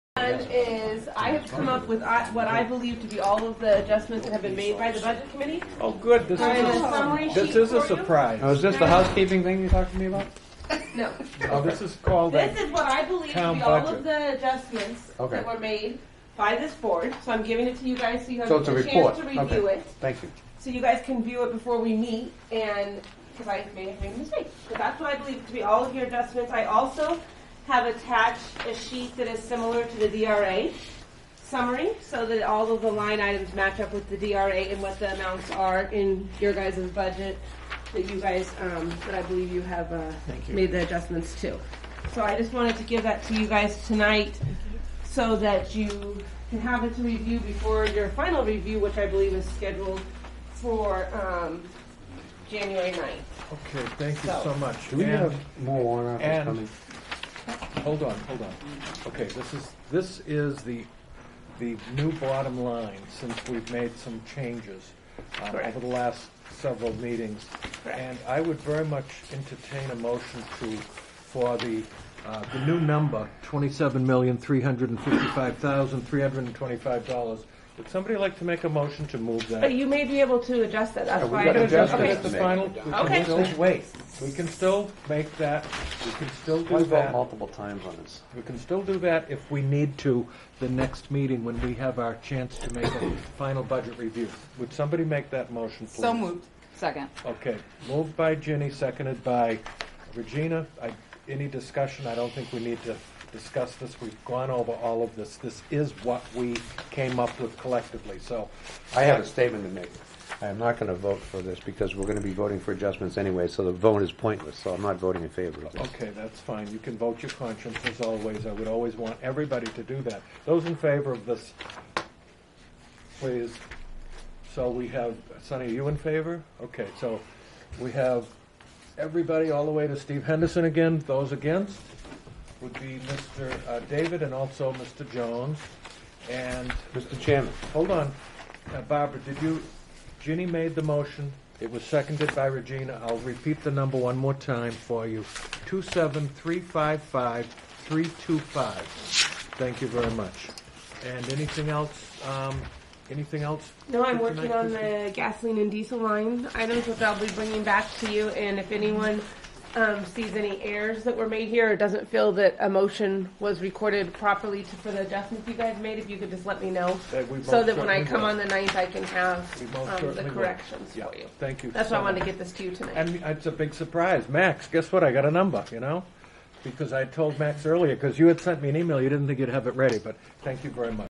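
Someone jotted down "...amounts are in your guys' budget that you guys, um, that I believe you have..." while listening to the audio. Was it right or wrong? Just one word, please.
right.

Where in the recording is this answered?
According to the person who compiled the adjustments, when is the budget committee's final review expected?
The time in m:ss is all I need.
0:52.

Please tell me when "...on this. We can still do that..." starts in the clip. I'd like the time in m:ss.
1:27.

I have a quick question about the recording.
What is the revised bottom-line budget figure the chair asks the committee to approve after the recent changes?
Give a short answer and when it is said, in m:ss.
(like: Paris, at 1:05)
$27,355,325, at 1:13.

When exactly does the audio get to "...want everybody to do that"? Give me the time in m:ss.
1:58.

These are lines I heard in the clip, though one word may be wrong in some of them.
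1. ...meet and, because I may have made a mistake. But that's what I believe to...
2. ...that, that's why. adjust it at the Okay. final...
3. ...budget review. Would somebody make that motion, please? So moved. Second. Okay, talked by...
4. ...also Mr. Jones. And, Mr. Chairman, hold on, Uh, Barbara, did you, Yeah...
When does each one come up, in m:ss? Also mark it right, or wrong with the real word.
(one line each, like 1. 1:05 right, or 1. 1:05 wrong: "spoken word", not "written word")
1. 0:21 right
2. 1:20 right
3. 1:33 wrong: "moved", not "talked"
4. 2:14 wrong: "Ginny", not "Yeah".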